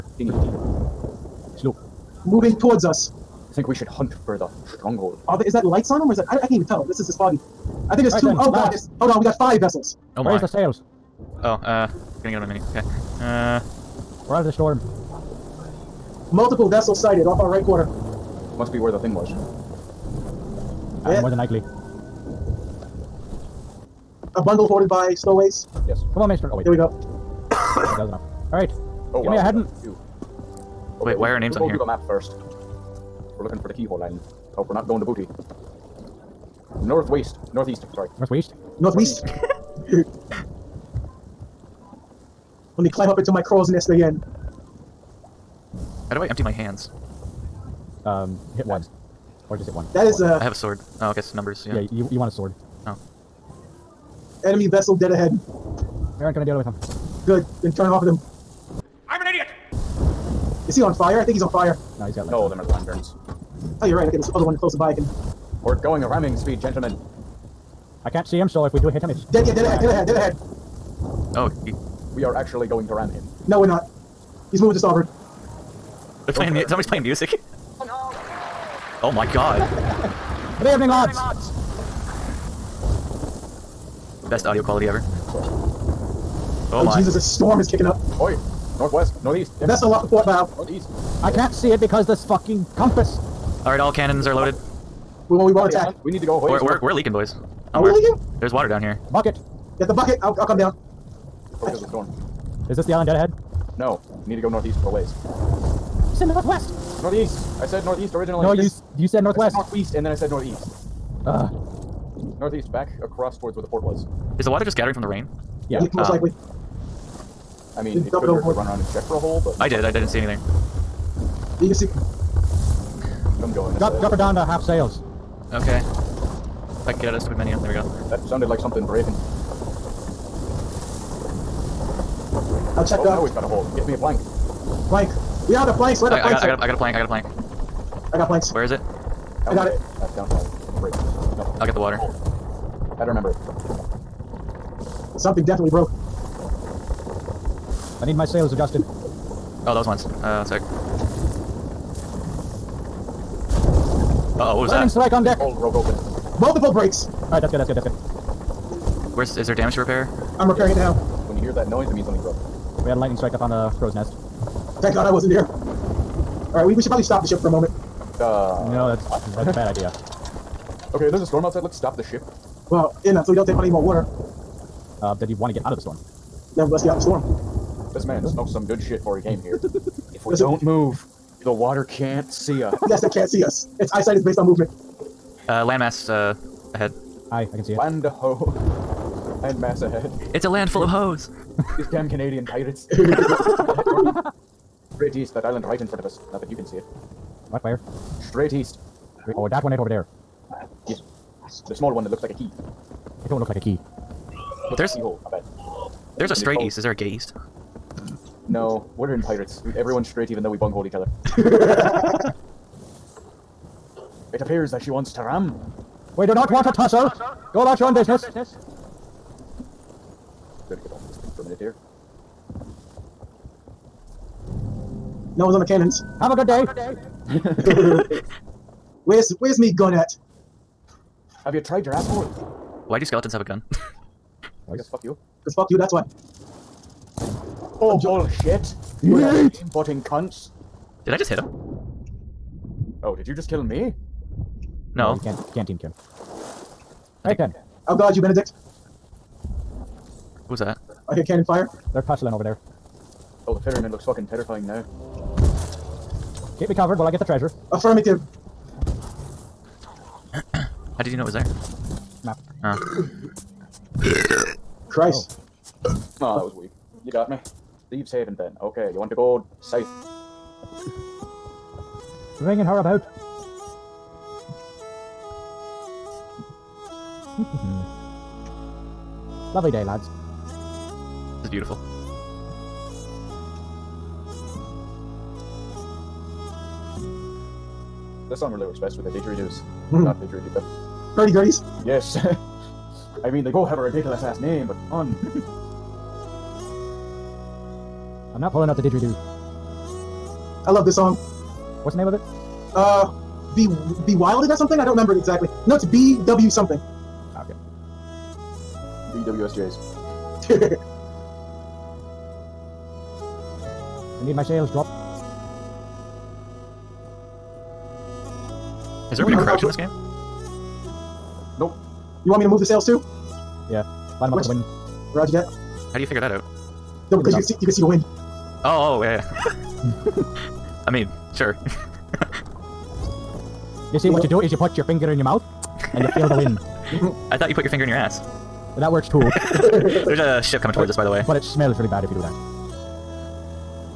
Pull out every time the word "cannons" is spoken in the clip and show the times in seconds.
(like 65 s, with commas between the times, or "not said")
93 s, 225 s, 251 s.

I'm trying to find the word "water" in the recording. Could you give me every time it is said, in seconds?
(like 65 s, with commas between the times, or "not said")
98 s, 114 s, 141 s, 173 s, 181 s.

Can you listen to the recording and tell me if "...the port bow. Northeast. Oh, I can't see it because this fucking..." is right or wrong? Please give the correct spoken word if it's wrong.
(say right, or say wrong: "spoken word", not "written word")
right.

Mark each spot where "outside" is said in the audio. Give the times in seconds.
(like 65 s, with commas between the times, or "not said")
171 s.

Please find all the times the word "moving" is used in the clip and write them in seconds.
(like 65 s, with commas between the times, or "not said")
2 s, 74 s.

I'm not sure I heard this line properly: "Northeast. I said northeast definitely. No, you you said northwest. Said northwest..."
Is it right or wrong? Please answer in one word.
wrong.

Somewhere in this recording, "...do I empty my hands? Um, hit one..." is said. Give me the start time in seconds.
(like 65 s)
46 s.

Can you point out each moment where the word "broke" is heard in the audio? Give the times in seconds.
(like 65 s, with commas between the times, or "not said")
145 s, 155 s, 162 s.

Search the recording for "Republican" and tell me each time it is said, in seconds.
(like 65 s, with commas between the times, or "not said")
not said.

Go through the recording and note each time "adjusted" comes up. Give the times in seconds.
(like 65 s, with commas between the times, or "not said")
148 s.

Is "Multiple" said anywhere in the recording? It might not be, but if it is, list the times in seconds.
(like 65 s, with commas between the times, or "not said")
16 s, 156 s.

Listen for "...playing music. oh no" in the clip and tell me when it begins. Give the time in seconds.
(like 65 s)
76 s.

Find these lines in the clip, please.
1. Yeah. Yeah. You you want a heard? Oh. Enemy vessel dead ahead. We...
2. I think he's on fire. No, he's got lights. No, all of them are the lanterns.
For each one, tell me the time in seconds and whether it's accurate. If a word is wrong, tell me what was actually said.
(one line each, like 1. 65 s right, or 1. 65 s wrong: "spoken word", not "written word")
1. 51 s wrong: "sword", not "heard"
2. 61 s right.